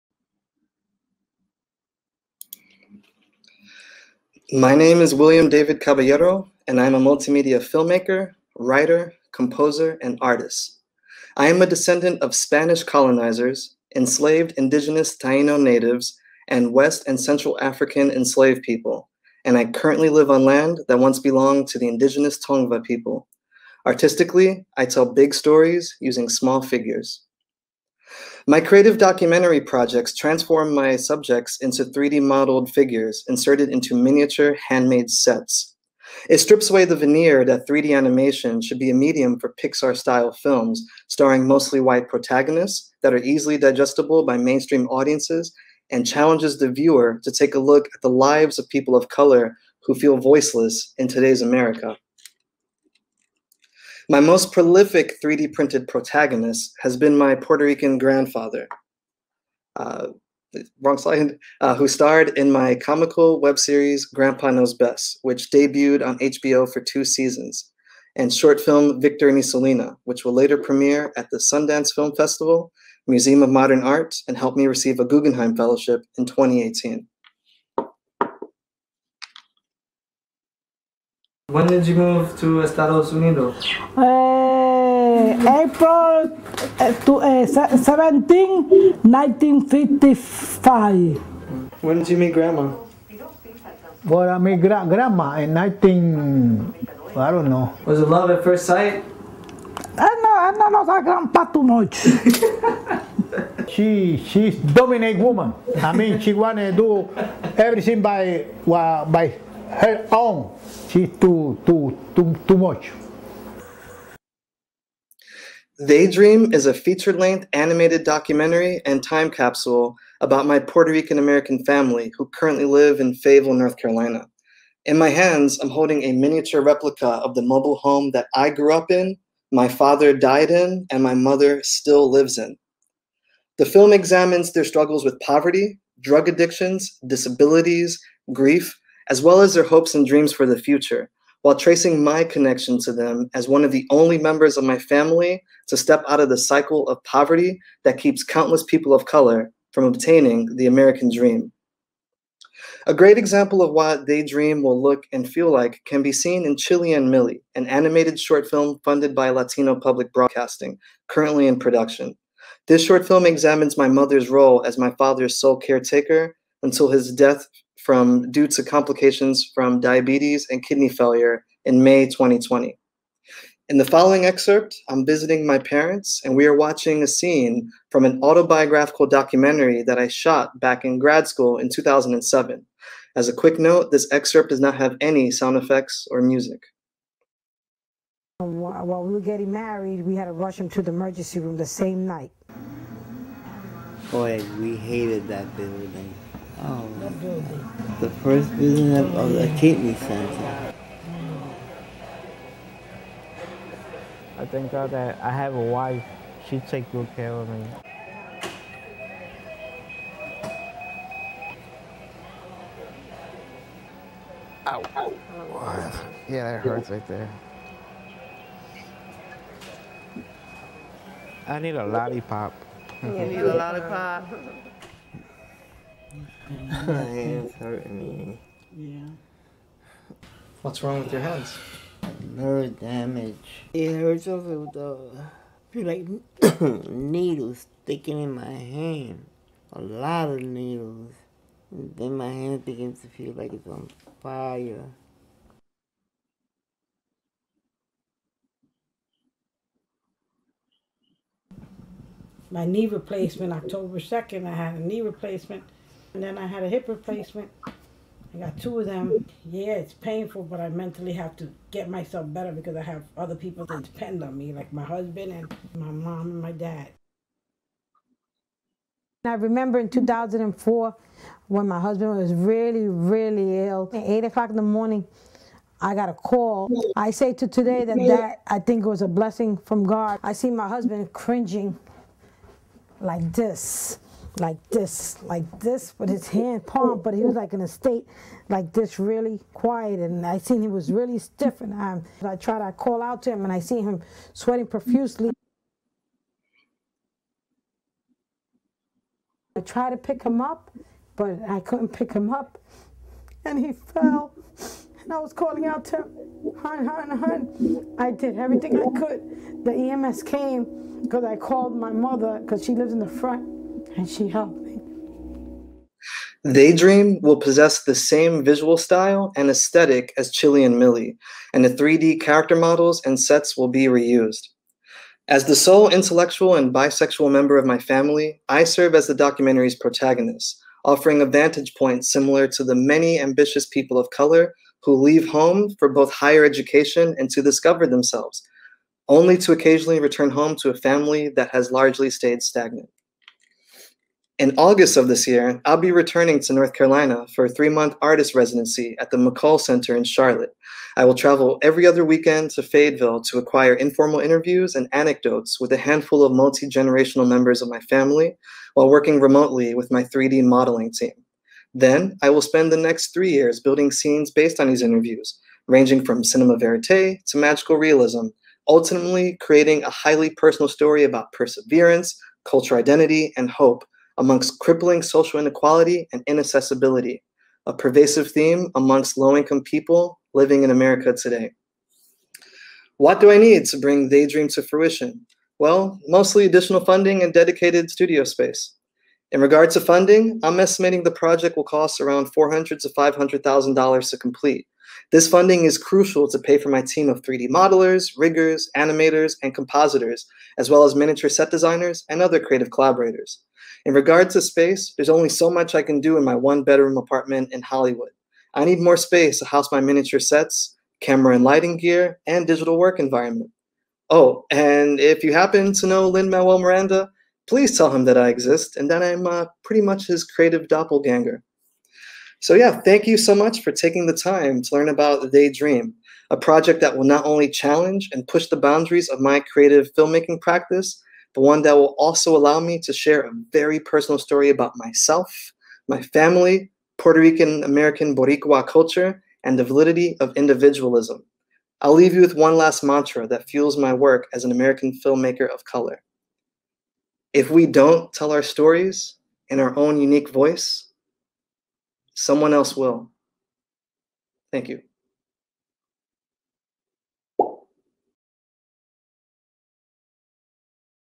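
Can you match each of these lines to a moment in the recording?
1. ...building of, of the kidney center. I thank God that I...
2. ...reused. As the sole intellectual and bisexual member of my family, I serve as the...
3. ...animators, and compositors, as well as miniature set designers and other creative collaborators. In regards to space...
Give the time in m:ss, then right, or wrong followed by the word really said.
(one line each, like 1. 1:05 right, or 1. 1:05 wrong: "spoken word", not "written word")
1. 3:18 right
2. 5:23 right
3. 6:38 right.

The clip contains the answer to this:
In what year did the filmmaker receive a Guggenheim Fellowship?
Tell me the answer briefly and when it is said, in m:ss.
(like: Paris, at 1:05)
2018, at 1:16.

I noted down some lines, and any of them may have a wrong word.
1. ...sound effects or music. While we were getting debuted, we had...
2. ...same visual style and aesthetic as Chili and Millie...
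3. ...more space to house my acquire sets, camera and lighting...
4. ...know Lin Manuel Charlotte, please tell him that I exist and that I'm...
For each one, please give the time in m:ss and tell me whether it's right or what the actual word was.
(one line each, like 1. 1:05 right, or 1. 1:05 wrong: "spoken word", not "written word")
1. 3:05 wrong: "married", not "debuted"
2. 5:17 right
3. 6:48 wrong: "miniature", not "acquire"
4. 6:55 wrong: "Miranda", not "Charlotte".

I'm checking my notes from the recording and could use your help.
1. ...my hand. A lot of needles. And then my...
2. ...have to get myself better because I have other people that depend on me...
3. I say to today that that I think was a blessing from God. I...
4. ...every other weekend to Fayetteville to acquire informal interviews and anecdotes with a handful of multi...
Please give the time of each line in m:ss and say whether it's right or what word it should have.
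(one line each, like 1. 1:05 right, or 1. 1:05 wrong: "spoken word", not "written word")
1. 3:58 right
2. 4:21 right
3. 4:36 right
4. 5:51 right.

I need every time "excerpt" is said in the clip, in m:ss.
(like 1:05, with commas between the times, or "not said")
2:54, 3:04.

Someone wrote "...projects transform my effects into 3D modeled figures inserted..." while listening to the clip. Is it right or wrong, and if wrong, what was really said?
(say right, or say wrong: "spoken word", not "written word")
wrong: "subjects", not "effects".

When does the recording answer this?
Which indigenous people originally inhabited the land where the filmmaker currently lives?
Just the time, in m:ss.
0:22.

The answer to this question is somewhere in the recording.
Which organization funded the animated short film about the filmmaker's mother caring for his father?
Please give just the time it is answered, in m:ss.
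2:39.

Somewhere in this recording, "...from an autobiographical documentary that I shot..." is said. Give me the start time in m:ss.
2:57.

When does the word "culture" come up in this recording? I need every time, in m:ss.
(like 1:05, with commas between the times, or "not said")
6:12, 7:18.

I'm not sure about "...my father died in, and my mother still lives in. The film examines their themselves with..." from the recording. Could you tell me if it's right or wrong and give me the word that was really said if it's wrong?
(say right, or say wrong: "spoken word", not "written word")
wrong: "struggles", not "themselves".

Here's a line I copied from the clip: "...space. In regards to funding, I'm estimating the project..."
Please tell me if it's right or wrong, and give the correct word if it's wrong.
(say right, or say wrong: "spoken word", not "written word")
right.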